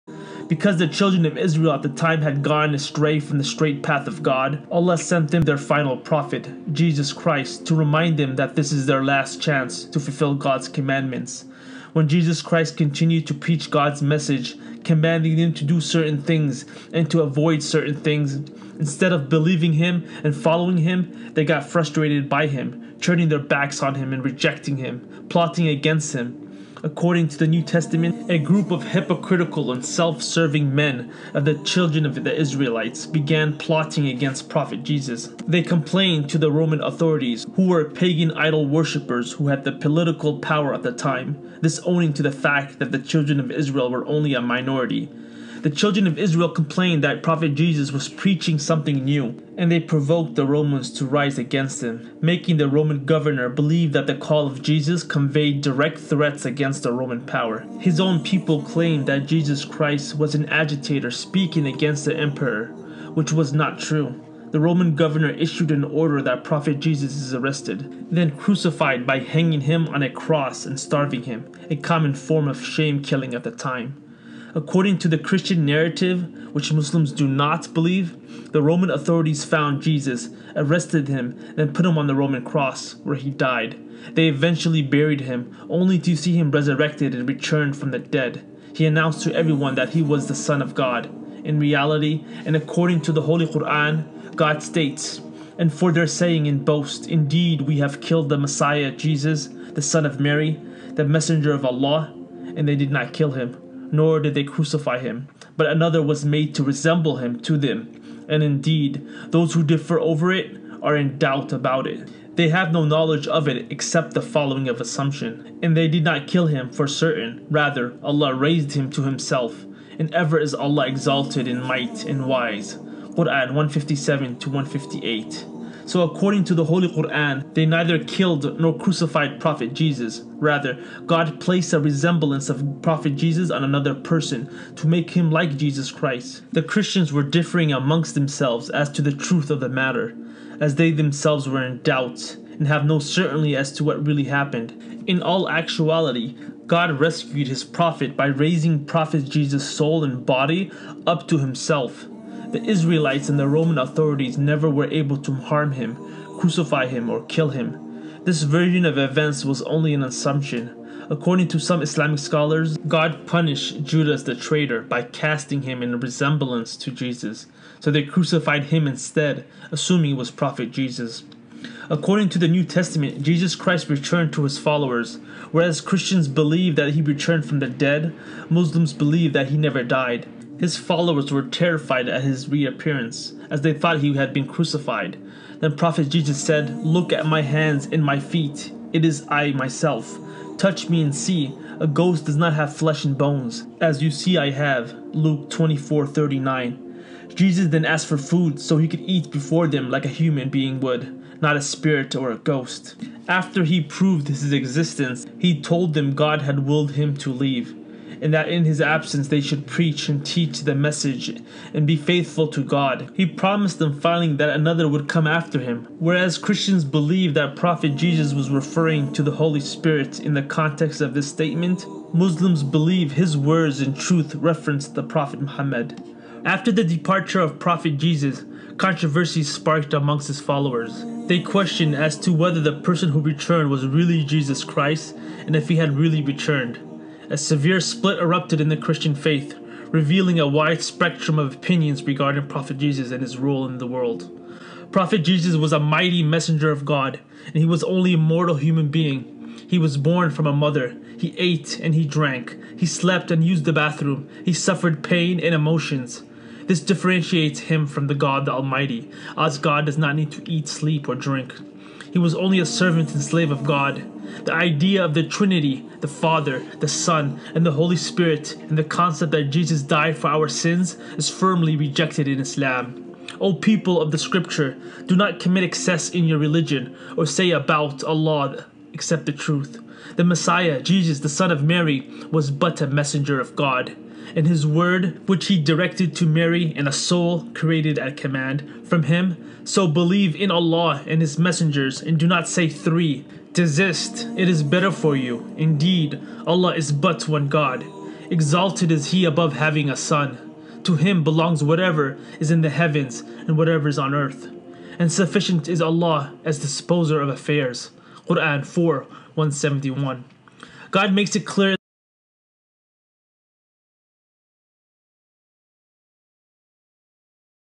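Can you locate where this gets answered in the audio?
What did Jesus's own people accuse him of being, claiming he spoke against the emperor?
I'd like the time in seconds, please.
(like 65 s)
60 s.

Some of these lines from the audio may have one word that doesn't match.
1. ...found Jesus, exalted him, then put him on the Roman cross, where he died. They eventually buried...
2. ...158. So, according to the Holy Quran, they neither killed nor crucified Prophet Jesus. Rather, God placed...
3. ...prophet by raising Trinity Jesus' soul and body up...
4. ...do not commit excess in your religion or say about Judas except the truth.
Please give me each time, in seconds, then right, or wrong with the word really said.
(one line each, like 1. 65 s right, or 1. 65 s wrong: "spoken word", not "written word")
1. 79 s wrong: "arrested", not "exalted"
2. 124 s right
3. 147 s wrong: "Prophet", not "Trinity"
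4. 275 s wrong: "Allah", not "Judas".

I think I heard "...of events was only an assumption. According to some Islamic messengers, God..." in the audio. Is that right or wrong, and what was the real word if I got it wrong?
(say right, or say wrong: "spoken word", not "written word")
wrong: "scholars", not "messengers".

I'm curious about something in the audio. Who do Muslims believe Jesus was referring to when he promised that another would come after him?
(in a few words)
Prophet Muhammad.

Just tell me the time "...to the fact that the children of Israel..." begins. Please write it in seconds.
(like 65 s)
42 s.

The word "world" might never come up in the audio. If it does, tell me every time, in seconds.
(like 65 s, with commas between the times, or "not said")
243 s.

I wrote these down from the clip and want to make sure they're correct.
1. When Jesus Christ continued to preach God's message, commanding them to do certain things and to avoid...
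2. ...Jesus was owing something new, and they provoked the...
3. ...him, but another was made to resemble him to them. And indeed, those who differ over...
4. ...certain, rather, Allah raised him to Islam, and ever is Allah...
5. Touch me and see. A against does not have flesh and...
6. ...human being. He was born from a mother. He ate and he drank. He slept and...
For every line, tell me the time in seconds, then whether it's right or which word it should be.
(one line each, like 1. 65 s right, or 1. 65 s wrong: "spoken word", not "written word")
1. 11 s right
2. 47 s wrong: "preaching", not "owing"
3. 104 s right
4. 116 s wrong: "Himself", not "Islam"
5. 190 s wrong: "ghost", not "against"
6. 248 s right.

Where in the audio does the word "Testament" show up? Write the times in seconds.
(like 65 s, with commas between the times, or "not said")
27 s, 172 s.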